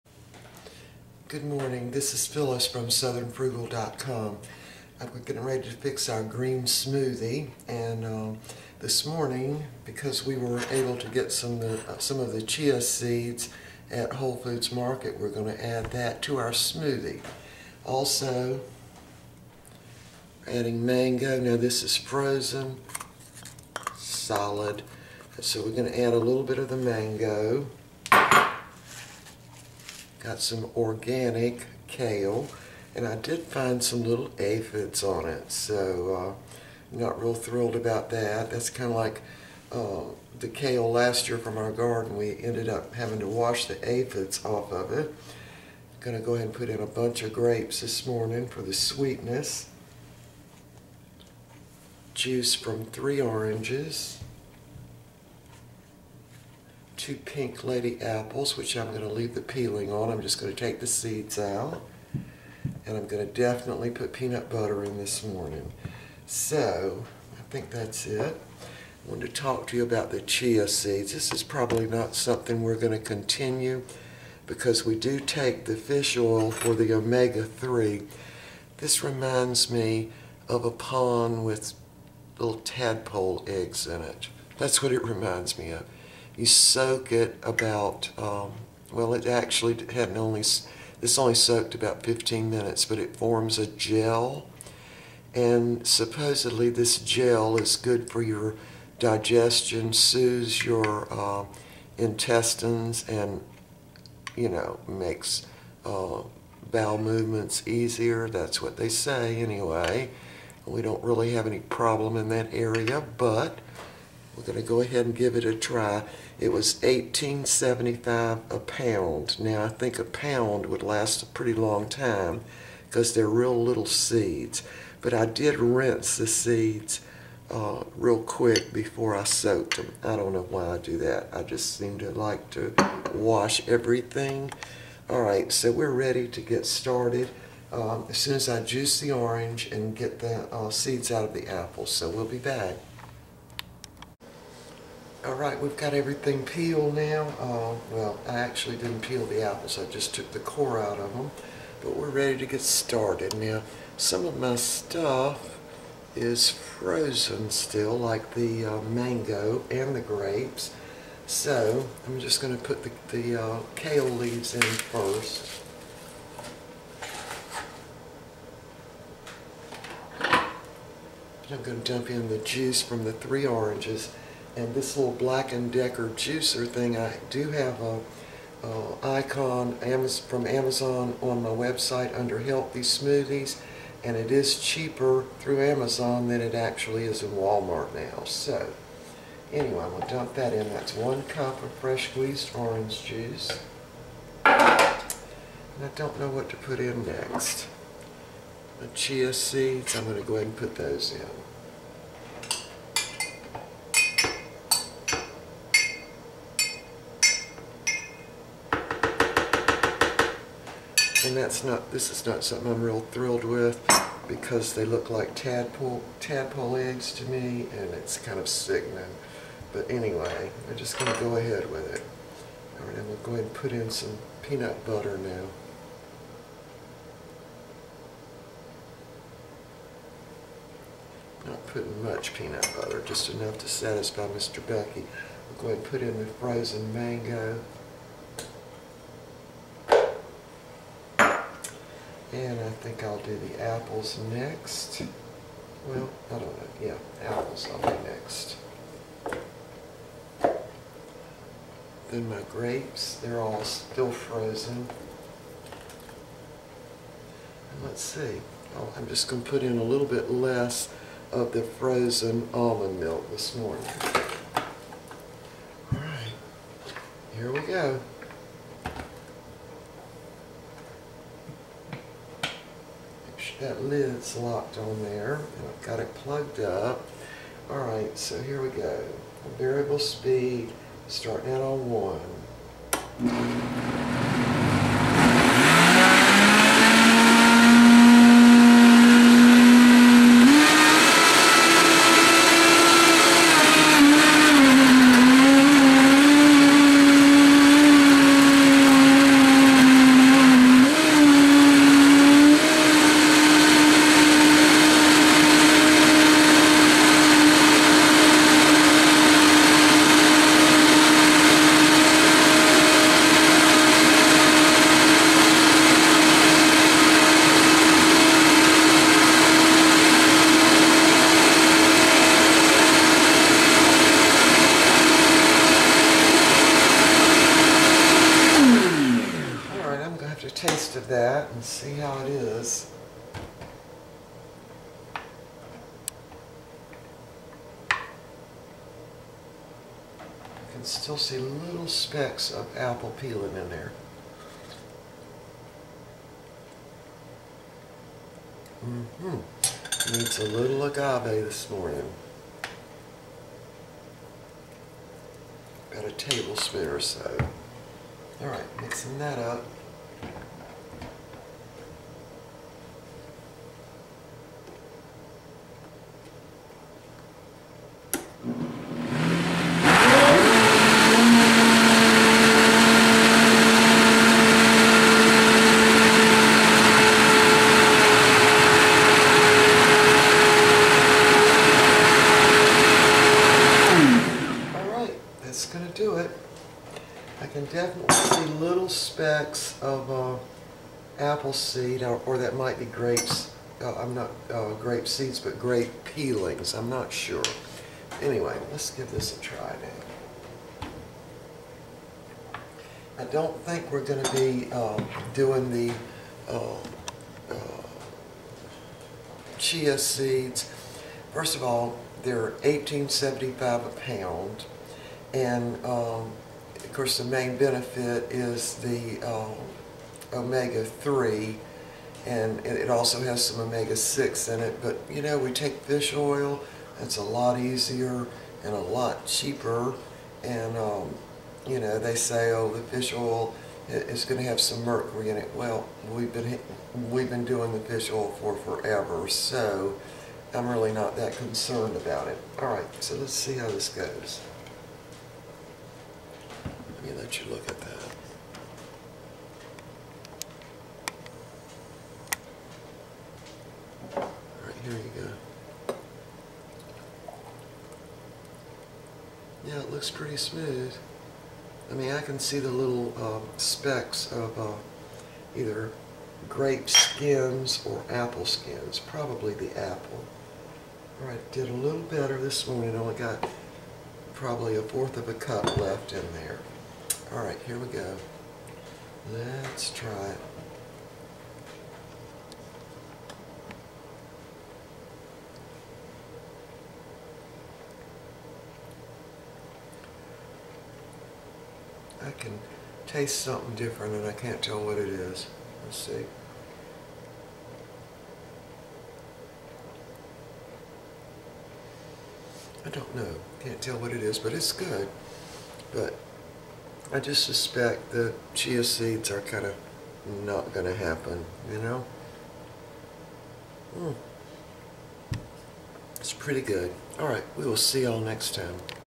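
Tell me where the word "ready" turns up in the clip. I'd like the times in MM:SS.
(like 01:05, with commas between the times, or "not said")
00:05, 02:15, 02:32.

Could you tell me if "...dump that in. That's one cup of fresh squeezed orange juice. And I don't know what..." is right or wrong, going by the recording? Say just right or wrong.
right.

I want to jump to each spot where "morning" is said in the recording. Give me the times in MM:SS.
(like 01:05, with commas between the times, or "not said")
00:01, 00:09, 00:48, 01:05, 04:23, 05:51, 07:52.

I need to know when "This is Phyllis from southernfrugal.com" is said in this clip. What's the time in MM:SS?
00:01.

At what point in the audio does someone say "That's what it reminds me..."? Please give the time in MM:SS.
01:24.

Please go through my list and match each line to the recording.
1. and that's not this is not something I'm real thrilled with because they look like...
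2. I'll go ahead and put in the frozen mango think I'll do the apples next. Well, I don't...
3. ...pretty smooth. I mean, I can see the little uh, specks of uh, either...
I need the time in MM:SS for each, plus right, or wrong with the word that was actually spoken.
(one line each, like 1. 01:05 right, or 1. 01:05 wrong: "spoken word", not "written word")
1. 03:31 right
2. 03:55 right
3. 07:40 right.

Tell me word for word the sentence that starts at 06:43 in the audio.
I don't think we're going to be um, doing the uh, uh, chia seeds.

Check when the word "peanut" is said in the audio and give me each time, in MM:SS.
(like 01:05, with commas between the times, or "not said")
01:04, 03:44, 03:52.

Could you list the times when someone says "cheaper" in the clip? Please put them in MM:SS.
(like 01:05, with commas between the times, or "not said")
03:04, 07:09.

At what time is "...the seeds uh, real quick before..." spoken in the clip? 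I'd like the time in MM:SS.
02:06.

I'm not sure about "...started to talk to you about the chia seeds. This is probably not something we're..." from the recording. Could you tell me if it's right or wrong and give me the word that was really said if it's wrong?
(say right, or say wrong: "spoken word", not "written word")
wrong: "wanted", not "started".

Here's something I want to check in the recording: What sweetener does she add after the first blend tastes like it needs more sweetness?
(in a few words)
agave.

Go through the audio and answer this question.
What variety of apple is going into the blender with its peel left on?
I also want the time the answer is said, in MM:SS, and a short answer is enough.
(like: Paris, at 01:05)
Pink Lady, at 00:57.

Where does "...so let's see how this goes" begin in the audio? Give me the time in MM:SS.
07:23.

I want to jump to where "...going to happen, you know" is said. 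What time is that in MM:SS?
08:30.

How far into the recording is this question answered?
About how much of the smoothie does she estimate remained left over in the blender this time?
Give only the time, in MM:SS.
07:54.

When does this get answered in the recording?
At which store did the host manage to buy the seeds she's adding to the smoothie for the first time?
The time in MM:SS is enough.
00:14.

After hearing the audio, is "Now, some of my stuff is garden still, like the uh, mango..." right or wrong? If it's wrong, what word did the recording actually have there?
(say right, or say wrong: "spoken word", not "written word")
wrong: "frozen", not "garden".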